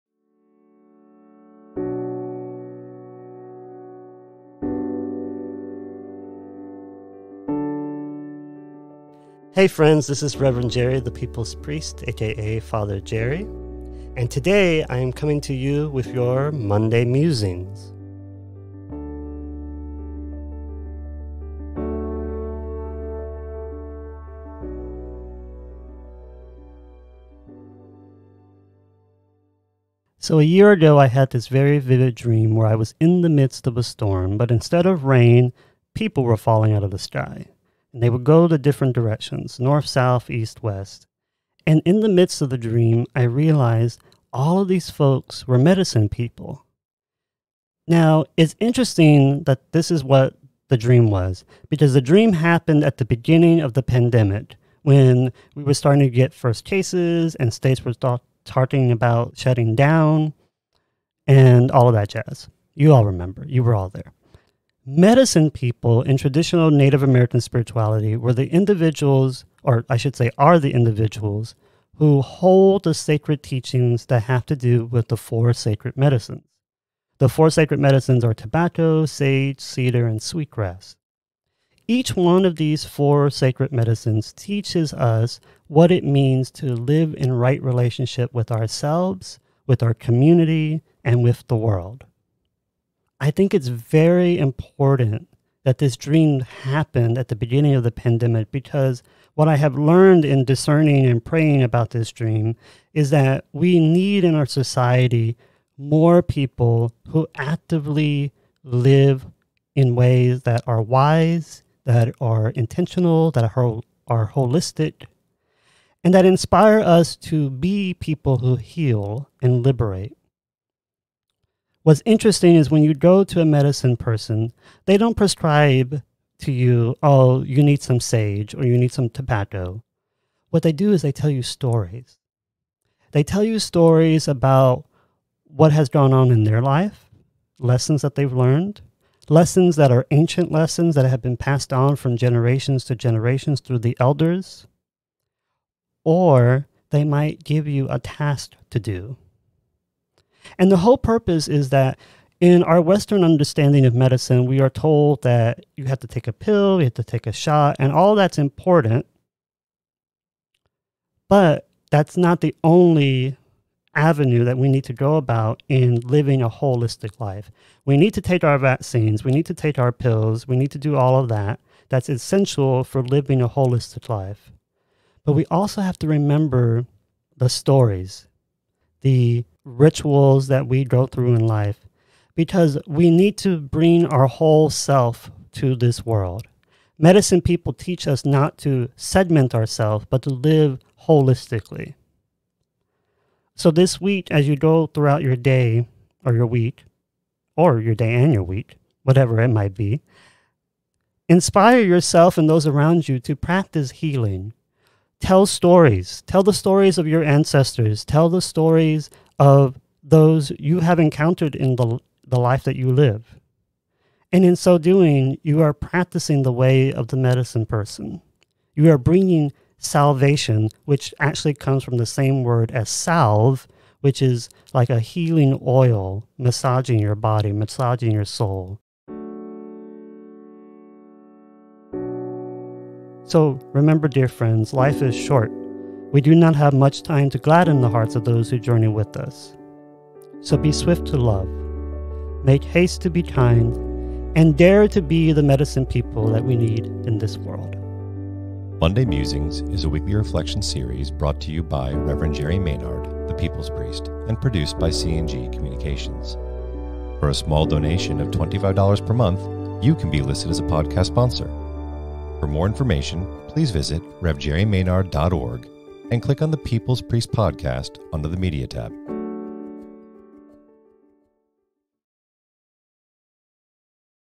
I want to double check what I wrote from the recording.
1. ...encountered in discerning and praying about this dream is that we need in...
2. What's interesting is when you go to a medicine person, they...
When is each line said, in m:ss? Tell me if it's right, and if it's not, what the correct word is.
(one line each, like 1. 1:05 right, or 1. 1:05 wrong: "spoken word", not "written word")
1. 1:39 wrong: "learned", not "encountered"
2. 2:01 right.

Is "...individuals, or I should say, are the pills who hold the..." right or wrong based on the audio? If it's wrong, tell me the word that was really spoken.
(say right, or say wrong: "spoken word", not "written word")
wrong: "individuals", not "pills".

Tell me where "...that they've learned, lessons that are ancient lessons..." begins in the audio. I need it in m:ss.
2:18.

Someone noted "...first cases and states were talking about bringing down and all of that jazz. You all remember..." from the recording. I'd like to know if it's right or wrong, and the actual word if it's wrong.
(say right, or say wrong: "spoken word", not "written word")
wrong: "shutting", not "bringing".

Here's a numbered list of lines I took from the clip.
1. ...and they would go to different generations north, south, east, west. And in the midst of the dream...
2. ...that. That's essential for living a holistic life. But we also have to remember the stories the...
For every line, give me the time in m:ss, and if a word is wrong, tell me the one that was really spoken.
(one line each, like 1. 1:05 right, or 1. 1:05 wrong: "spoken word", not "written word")
1. 0:37 wrong: "directions", not "generations"
2. 2:51 right.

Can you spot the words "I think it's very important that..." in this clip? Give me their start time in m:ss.
1:33.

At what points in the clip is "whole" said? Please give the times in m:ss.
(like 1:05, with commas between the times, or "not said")
2:30, 3:04.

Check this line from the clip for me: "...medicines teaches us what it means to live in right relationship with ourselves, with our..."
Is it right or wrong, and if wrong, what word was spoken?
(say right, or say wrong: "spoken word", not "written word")
right.